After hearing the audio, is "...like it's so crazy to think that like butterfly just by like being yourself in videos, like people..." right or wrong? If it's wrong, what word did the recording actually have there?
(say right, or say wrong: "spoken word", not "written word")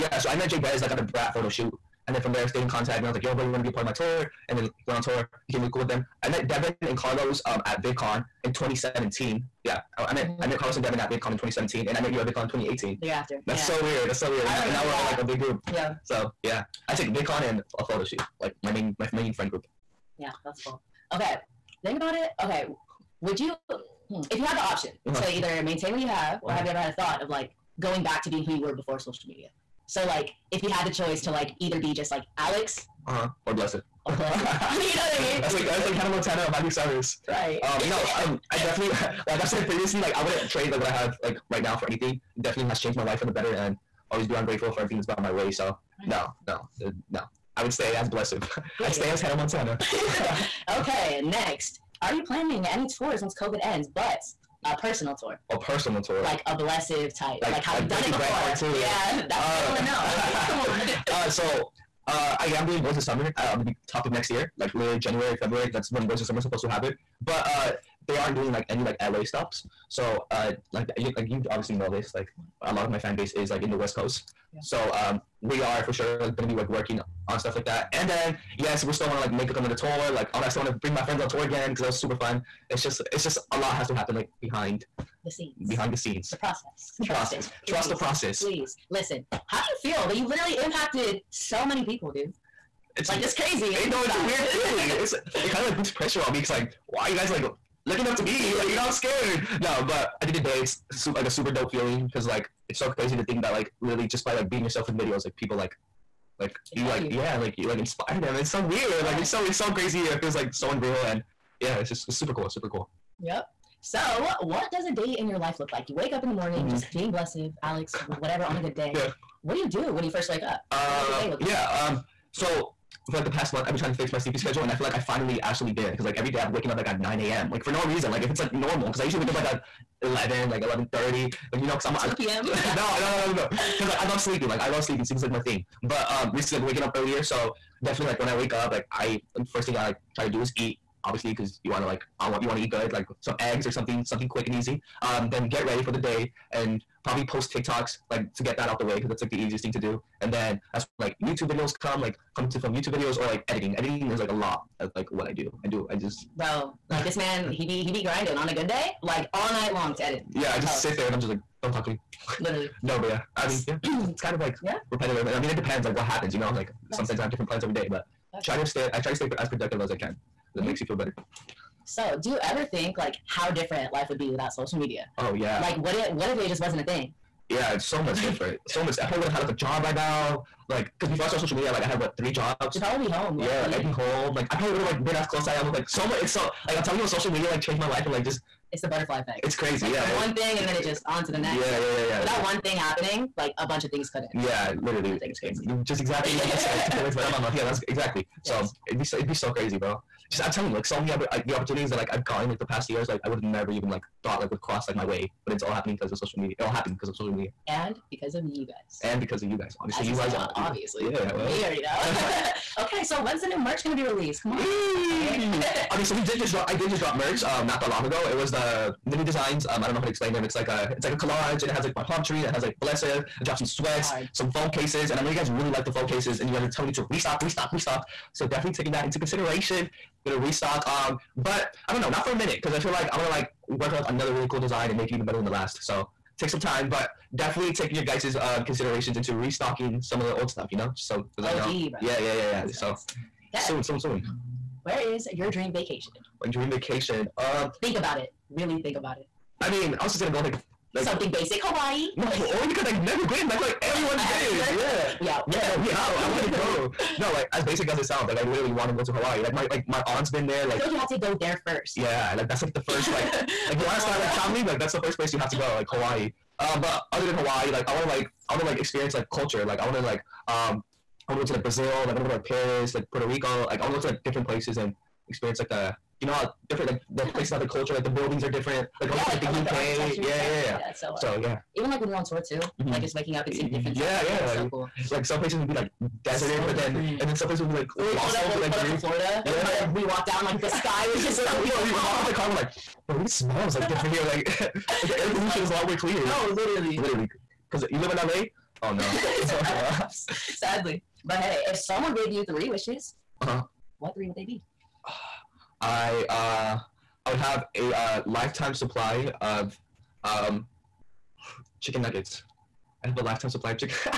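wrong: "literally", not "butterfly".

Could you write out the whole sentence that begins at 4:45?
Like some places would be like deserted, so but then and then some places would be like when we blossomed.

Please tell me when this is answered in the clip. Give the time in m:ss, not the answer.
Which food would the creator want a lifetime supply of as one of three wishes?
5:11.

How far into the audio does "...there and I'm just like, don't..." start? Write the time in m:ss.
2:40.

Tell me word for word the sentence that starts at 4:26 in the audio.
Um, but other than Hawaii, like I want to like I want to like experience like culture.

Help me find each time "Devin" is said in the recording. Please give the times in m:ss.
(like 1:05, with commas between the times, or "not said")
0:06, 0:10.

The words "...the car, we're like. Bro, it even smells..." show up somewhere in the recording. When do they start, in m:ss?
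4:52.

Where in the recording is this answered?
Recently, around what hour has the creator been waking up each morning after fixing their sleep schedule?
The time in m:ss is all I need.
2:06.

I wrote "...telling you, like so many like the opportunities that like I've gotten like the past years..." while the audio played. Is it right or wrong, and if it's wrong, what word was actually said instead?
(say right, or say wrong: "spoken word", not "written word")
right.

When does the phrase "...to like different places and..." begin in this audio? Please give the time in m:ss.
4:33.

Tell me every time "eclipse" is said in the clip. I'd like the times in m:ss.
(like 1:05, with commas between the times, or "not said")
not said.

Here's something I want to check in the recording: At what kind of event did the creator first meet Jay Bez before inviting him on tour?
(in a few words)
Brat photo shoot.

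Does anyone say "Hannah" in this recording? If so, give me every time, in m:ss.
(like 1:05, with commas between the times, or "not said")
0:35, 0:49.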